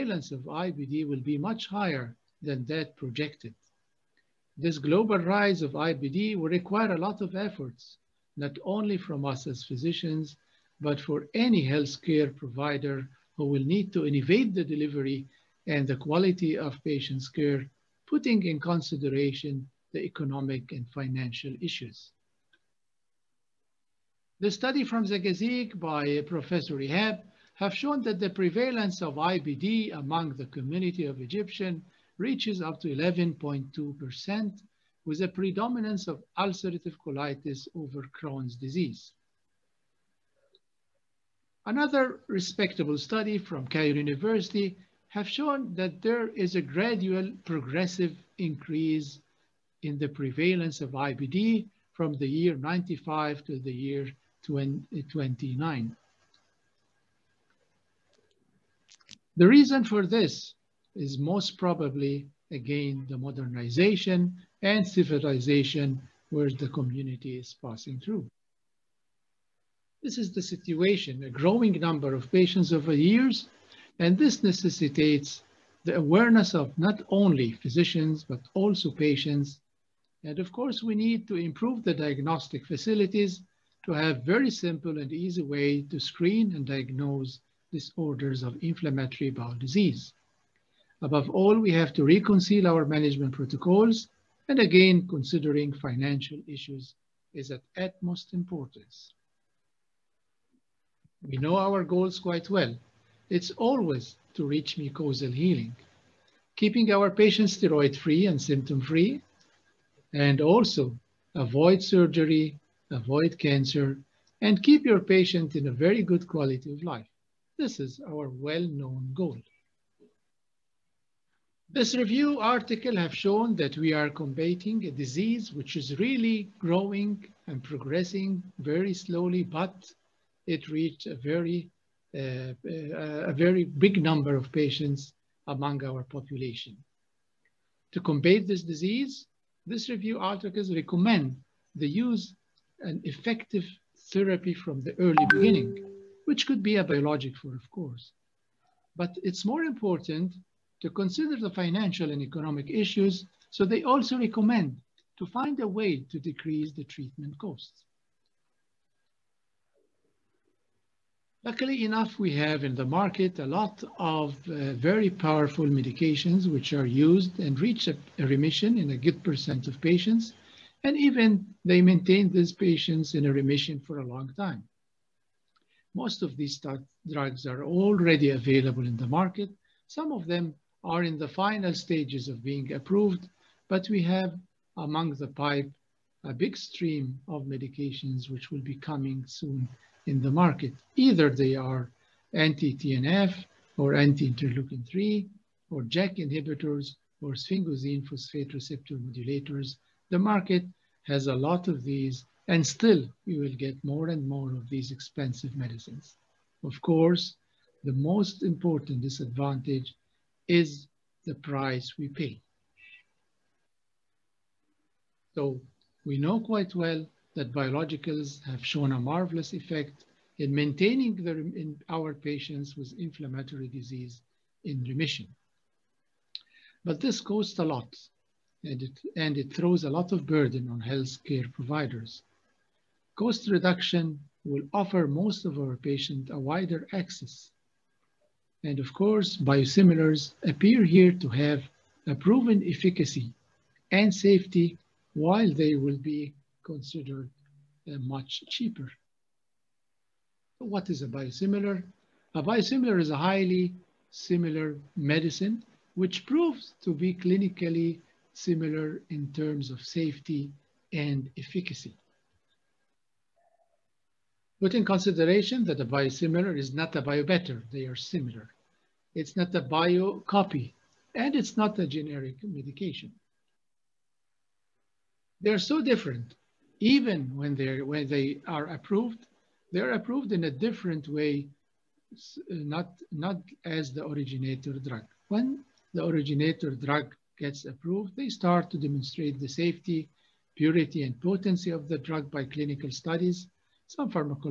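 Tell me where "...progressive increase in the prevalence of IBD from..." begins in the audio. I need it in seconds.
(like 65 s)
47 s.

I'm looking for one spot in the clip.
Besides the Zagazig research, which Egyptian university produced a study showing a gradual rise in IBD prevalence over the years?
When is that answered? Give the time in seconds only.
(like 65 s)
43 s.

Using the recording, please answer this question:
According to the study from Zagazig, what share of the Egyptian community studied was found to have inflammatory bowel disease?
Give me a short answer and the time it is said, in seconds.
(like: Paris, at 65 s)
11.2%, at 32 s.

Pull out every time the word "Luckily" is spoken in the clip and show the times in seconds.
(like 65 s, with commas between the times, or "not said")
161 s.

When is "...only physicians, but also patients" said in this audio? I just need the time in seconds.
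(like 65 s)
77 s.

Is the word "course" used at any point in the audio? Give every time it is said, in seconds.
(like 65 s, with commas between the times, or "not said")
80 s, 147 s, 206 s, 238 s.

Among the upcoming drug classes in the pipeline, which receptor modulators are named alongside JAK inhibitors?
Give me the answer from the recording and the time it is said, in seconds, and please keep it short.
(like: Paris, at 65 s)
sphingosine phosphate receptor modulators, at 197 s.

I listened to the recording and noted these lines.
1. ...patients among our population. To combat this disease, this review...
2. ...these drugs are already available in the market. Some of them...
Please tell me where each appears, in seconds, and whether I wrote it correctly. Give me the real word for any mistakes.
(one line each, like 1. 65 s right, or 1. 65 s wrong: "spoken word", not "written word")
1. 134 s right
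2. 176 s right.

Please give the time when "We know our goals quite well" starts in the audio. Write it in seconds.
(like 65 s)
101 s.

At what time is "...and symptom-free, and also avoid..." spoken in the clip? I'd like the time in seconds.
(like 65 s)
108 s.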